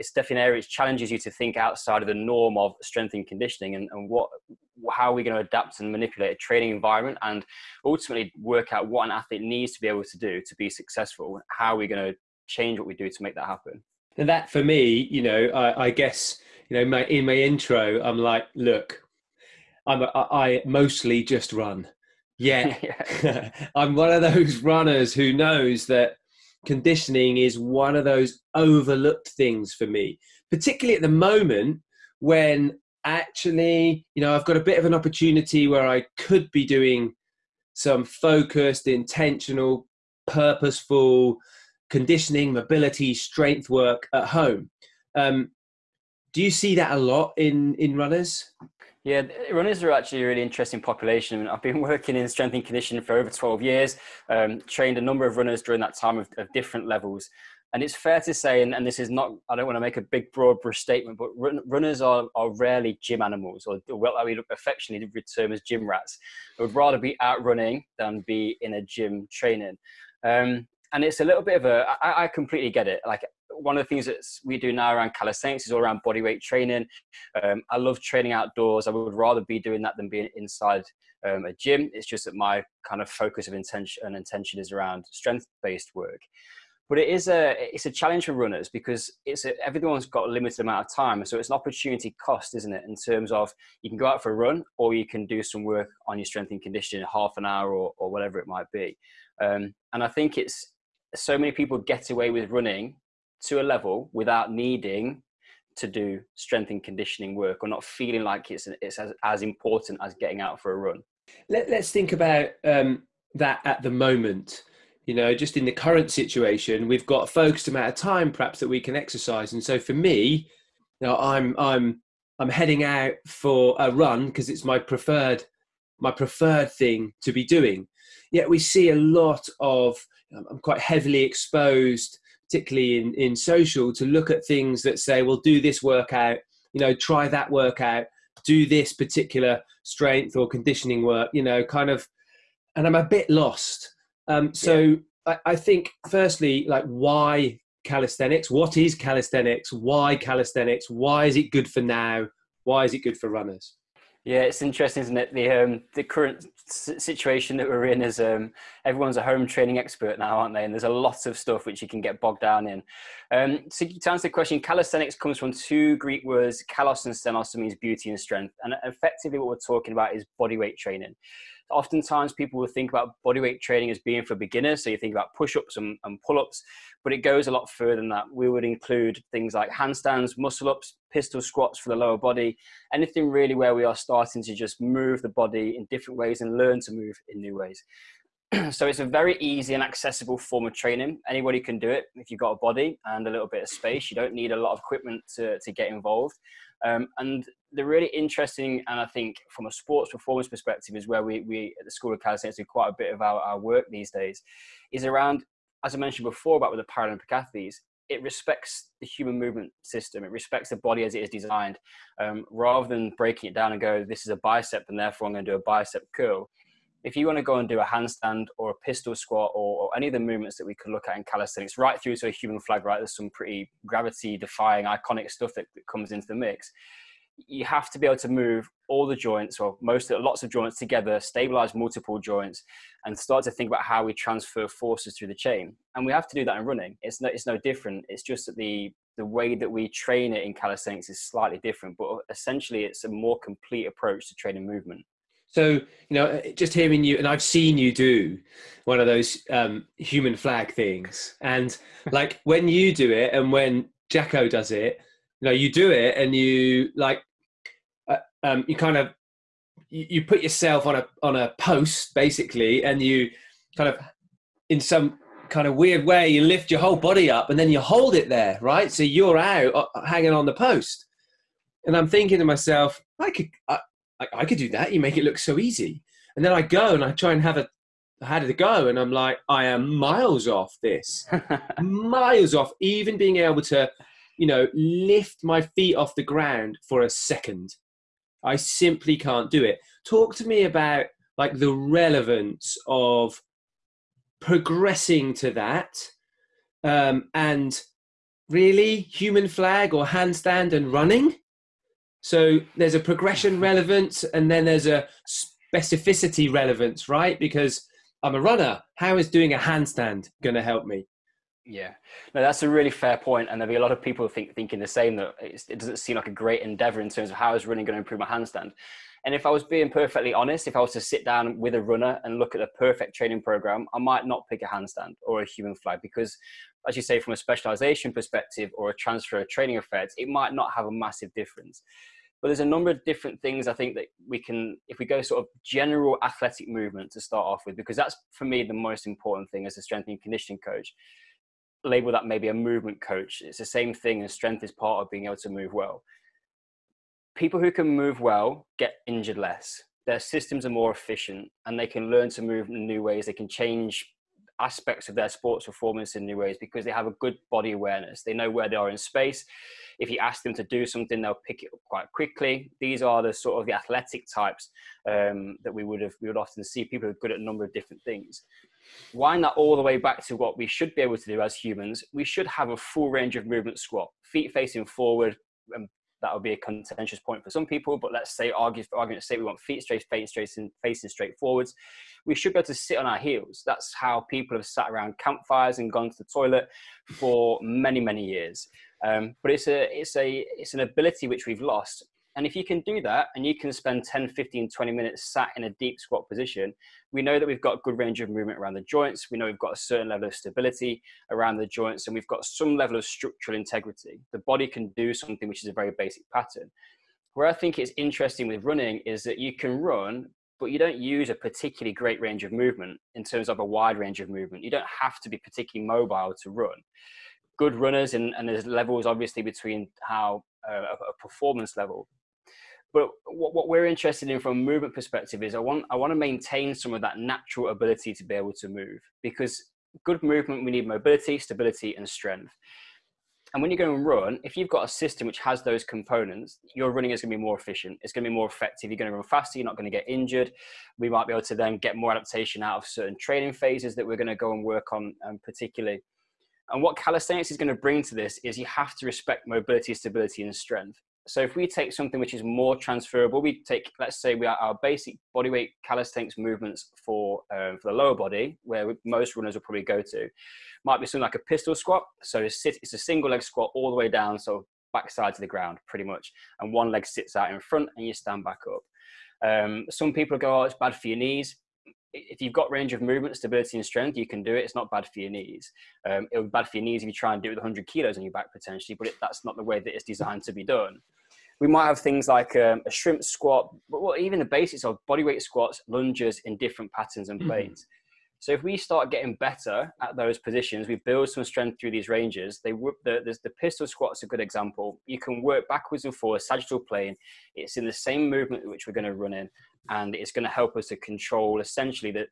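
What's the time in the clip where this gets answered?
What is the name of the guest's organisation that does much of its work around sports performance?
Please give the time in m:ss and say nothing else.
3:21.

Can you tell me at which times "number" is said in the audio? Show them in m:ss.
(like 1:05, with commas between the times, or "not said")
0:55, 5:32, 6:07.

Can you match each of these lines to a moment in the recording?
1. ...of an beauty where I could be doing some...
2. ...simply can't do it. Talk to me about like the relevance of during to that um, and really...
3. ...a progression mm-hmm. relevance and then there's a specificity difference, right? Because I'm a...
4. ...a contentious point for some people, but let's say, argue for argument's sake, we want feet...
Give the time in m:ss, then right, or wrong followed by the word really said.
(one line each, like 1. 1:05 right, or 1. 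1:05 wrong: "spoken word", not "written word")
1. 0:34 wrong: "opportunity", not "beauty"
2. 4:48 wrong: "progressing", not "during"
3. 5:02 wrong: "relevance", not "difference"
4. 6:16 right.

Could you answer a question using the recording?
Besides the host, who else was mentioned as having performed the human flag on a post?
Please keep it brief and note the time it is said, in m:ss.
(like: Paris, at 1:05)
Jacko, at 4:14.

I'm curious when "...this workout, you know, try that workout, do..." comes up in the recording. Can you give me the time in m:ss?
2:15.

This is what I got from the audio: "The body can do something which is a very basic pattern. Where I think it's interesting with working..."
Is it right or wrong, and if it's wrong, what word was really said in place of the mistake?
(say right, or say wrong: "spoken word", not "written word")
wrong: "running", not "working".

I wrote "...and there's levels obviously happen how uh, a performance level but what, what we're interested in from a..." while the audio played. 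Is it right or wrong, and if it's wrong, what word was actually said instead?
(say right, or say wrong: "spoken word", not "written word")
wrong: "between", not "happen".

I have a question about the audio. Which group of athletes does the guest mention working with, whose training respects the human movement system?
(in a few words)
Paralympic athletes.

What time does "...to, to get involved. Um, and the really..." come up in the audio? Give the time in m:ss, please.
3:15.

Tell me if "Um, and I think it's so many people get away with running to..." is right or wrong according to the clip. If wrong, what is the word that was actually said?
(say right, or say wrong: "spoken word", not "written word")
right.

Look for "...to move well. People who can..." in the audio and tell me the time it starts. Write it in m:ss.
5:45.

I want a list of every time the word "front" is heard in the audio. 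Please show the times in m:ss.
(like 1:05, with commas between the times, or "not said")
7:47.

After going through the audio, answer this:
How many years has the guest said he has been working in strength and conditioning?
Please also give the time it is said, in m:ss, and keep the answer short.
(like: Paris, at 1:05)
12, at 0:53.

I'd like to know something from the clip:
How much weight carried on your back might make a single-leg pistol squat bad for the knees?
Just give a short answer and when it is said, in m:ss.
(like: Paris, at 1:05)
100 kilos, at 7:57.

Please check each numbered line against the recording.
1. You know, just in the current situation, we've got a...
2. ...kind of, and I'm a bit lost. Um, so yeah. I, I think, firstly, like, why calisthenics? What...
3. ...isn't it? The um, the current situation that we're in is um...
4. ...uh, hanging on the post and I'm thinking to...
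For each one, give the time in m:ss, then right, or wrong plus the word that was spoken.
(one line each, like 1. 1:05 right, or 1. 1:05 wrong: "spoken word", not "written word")
1. 1:55 right
2. 2:21 right
3. 2:35 right
4. 4:29 right.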